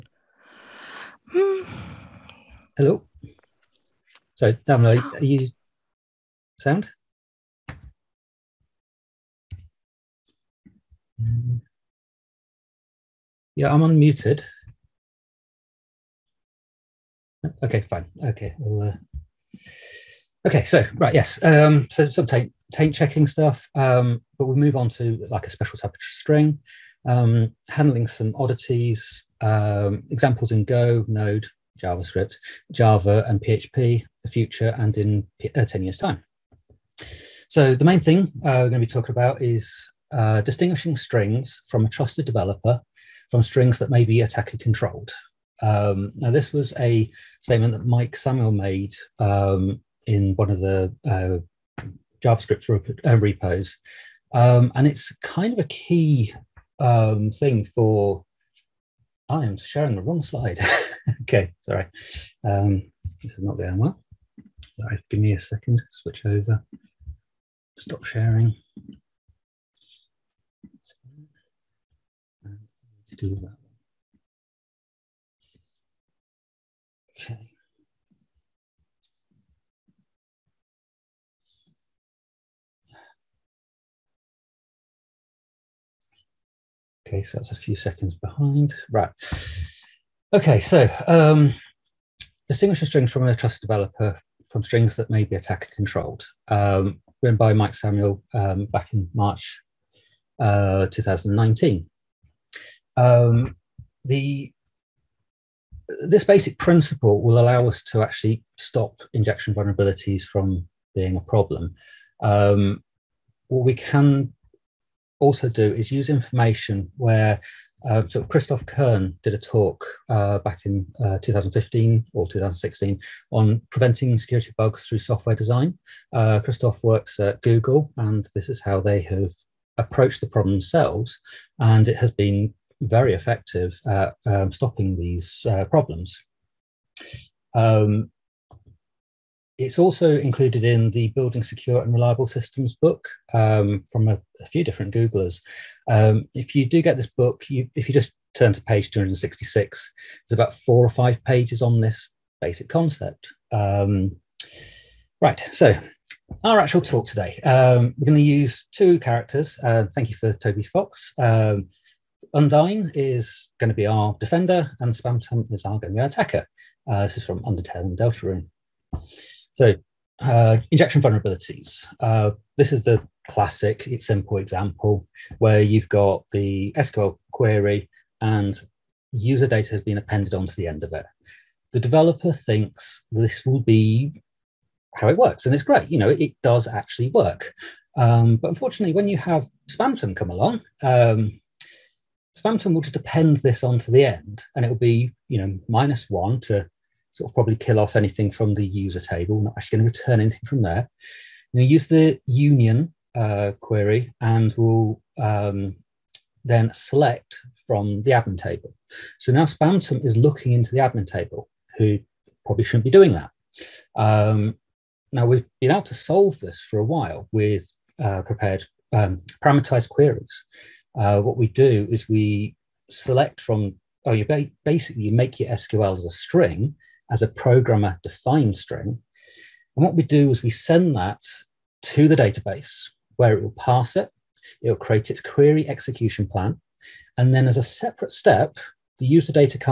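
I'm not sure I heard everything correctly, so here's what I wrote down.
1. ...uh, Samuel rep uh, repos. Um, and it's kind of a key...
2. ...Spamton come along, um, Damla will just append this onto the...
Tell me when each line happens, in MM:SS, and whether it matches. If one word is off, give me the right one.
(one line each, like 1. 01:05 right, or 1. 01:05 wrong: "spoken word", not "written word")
1. 00:51 wrong: "JavaScript", not "Samuel"
2. 03:09 wrong: "Spamton", not "Damla".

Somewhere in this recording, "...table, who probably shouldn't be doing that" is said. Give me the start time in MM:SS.
03:31.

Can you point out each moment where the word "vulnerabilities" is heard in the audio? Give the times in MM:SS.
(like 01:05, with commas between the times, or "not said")
01:49, 02:51.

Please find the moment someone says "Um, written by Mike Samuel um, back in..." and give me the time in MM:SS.
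01:36.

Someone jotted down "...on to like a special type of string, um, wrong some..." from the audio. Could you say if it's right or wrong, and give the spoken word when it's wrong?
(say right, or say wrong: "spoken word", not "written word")
wrong: "handling", not "wrong".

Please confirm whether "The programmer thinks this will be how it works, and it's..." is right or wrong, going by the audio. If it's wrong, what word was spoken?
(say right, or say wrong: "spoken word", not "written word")
wrong: "developer", not "programmer".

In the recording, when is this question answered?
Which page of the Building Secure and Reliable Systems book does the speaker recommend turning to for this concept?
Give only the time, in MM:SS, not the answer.
02:28.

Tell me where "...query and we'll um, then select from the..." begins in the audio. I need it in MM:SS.
03:23.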